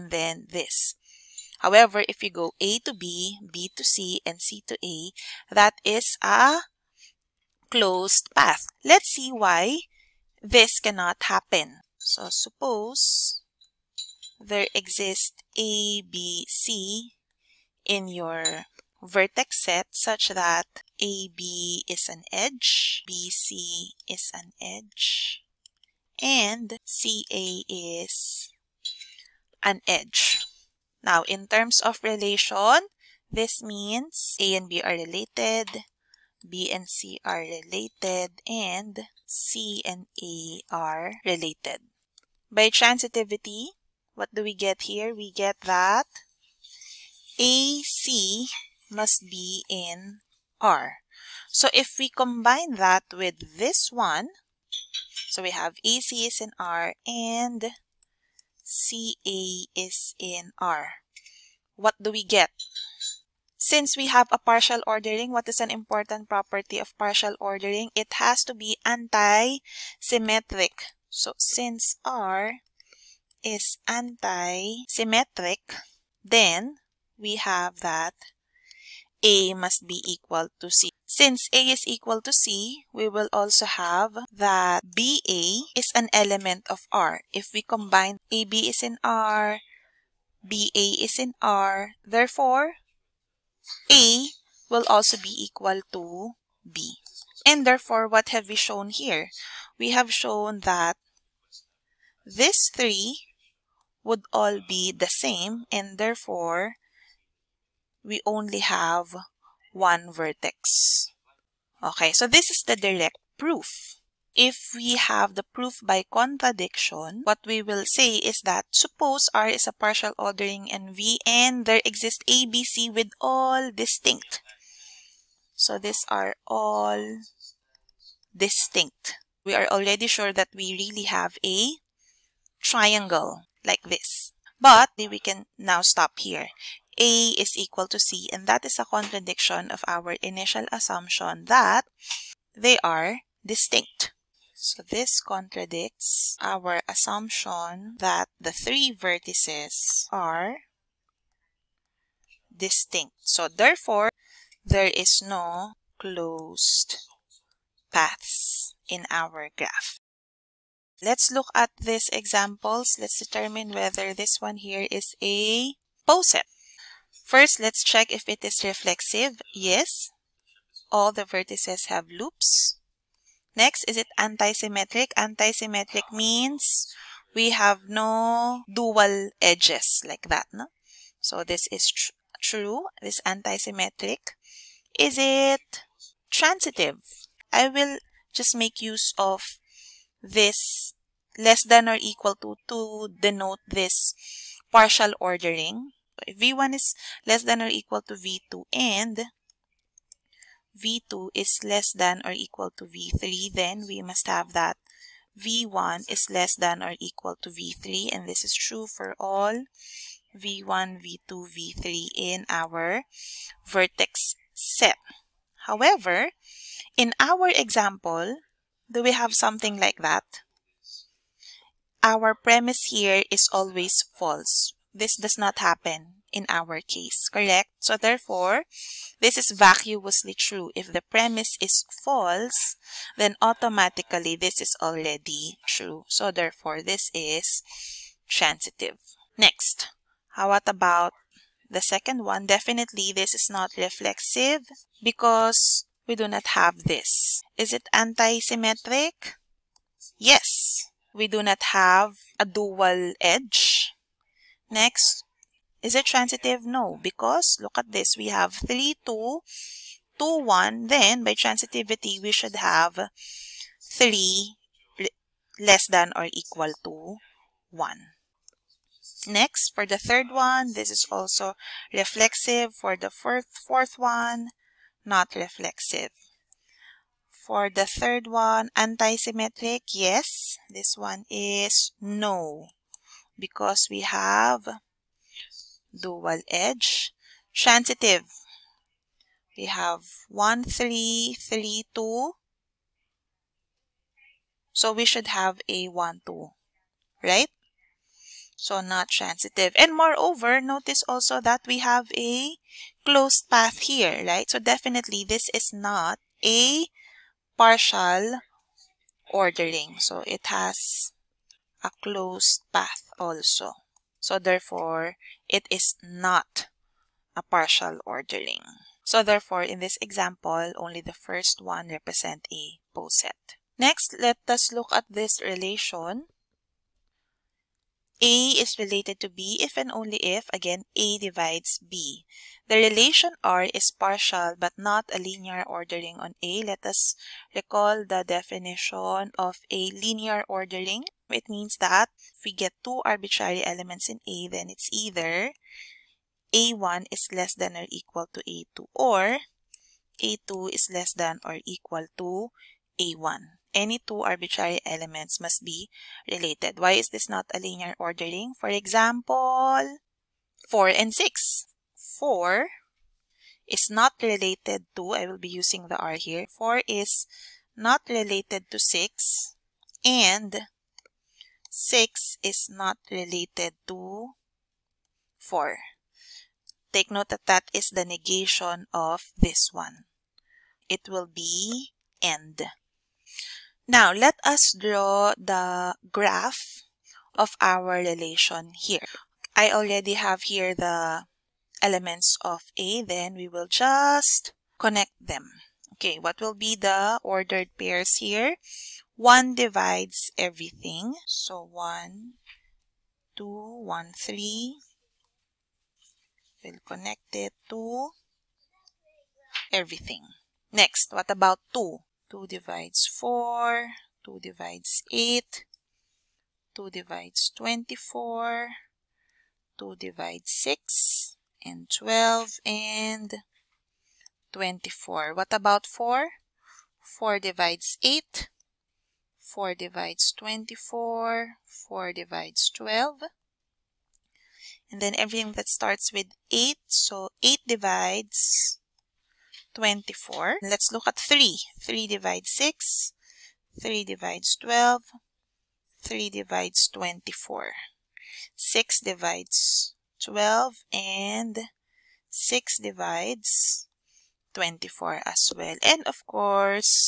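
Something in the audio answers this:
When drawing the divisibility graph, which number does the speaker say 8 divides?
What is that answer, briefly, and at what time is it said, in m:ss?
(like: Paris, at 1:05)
24, at 7:17.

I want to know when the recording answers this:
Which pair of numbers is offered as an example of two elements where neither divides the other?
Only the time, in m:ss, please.
6:00.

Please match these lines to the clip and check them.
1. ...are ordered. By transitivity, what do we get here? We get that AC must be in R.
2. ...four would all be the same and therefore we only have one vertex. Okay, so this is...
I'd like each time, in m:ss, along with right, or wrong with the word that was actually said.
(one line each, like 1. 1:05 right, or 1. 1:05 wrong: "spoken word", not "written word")
1. 0:40 wrong: "related", not "ordered"
2. 1:42 wrong: "three", not "four".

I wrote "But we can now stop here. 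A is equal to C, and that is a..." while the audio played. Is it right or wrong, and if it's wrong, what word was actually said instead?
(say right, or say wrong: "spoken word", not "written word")
right.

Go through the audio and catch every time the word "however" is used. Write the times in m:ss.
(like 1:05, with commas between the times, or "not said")
0:01, 3:35.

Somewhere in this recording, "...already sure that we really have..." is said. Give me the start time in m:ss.
2:09.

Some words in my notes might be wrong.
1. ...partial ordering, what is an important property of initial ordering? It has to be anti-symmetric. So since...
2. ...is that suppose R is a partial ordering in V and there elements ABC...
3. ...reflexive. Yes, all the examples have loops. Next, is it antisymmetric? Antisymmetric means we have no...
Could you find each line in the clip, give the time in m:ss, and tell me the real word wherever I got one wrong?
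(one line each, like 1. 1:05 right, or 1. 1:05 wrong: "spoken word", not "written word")
1. 1:04 wrong: "partial", not "initial"
2. 1:58 wrong: "exists", not "elements"
3. 2:48 wrong: "vertices", not "examples".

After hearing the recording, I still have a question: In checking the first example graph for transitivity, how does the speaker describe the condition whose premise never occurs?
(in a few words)
vacuously true.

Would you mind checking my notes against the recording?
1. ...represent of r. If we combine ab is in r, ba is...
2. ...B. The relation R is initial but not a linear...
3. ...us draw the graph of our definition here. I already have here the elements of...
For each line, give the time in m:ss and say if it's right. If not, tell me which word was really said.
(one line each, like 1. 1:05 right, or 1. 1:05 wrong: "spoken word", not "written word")
1. 1:26 wrong: "element", not "represent"
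2. 5:31 wrong: "partial", not "initial"
3. 6:24 wrong: "relation", not "definition".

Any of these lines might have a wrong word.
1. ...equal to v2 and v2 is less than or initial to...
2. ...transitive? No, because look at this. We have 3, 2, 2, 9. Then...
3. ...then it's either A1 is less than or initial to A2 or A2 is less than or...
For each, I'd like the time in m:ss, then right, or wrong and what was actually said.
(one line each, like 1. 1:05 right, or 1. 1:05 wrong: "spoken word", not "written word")
1. 3:17 wrong: "equal", not "initial"
2. 4:16 wrong: "1", not "9"
3. 5:44 wrong: "equal", not "initial".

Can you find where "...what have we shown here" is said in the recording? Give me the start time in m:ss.
1:38.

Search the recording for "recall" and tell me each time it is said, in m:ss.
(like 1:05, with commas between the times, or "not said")
5:37.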